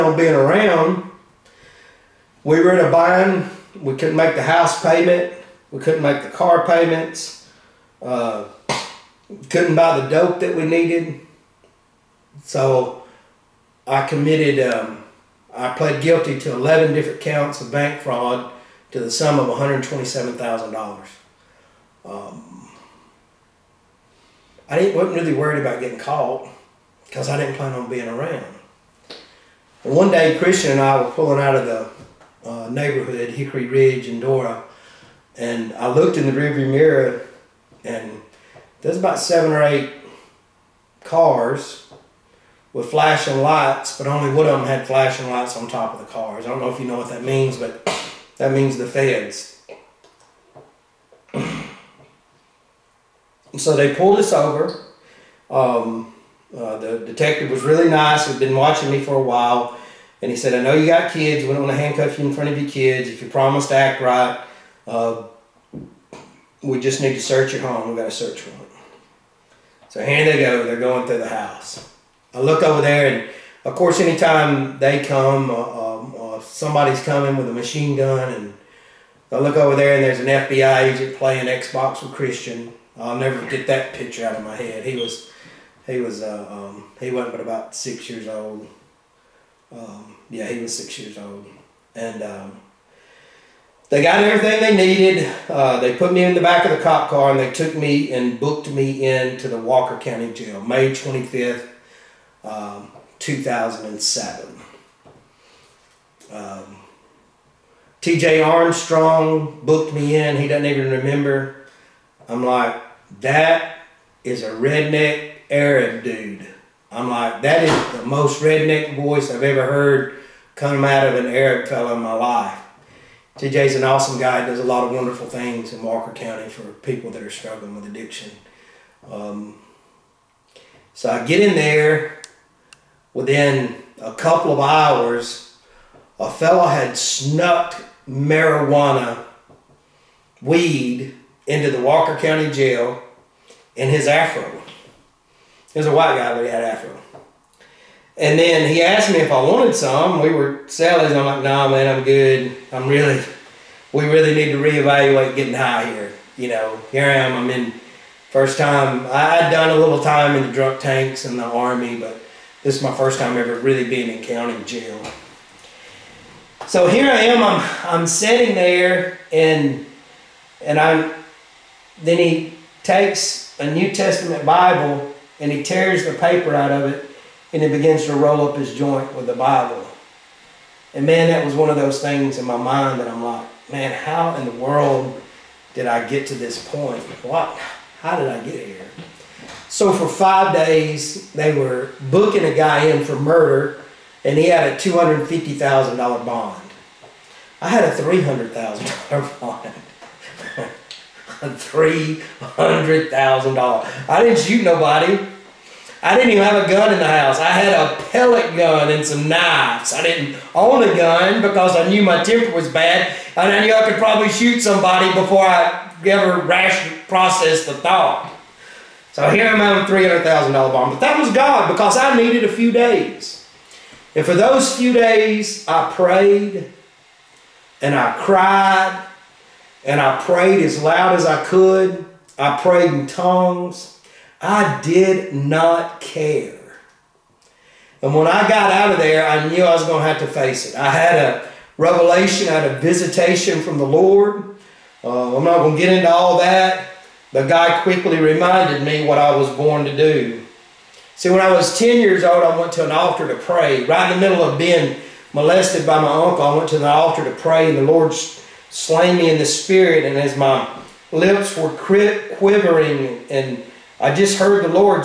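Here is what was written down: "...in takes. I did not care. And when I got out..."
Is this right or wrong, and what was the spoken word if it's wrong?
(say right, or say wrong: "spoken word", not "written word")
wrong: "tongues", not "takes".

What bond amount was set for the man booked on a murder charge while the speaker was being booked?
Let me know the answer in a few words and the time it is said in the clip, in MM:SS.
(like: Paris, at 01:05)
$250,000, at 03:14.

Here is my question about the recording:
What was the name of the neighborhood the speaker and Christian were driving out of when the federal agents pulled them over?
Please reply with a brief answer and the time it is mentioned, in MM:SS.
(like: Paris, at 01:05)
Hickory Ridge, at 00:33.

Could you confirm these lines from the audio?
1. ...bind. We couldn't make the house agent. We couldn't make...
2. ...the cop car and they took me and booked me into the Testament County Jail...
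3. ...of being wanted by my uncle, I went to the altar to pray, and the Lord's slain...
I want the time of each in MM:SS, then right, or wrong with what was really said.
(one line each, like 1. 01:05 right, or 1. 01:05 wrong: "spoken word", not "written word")
1. 00:02 wrong: "payment", not "agent"
2. 01:36 wrong: "Walker", not "Testament"
3. 04:14 wrong: "molested", not "wanted".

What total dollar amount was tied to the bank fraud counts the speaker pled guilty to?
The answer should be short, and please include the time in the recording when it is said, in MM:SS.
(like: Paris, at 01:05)
$127,000, at 00:19.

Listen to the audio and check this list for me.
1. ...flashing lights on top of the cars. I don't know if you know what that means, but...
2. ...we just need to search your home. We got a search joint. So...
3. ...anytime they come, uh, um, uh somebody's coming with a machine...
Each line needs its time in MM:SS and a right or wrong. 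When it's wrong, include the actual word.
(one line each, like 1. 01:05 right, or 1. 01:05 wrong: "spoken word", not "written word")
1. 00:44 right
2. 01:06 wrong: "warrant", not "joint"
3. 01:13 right.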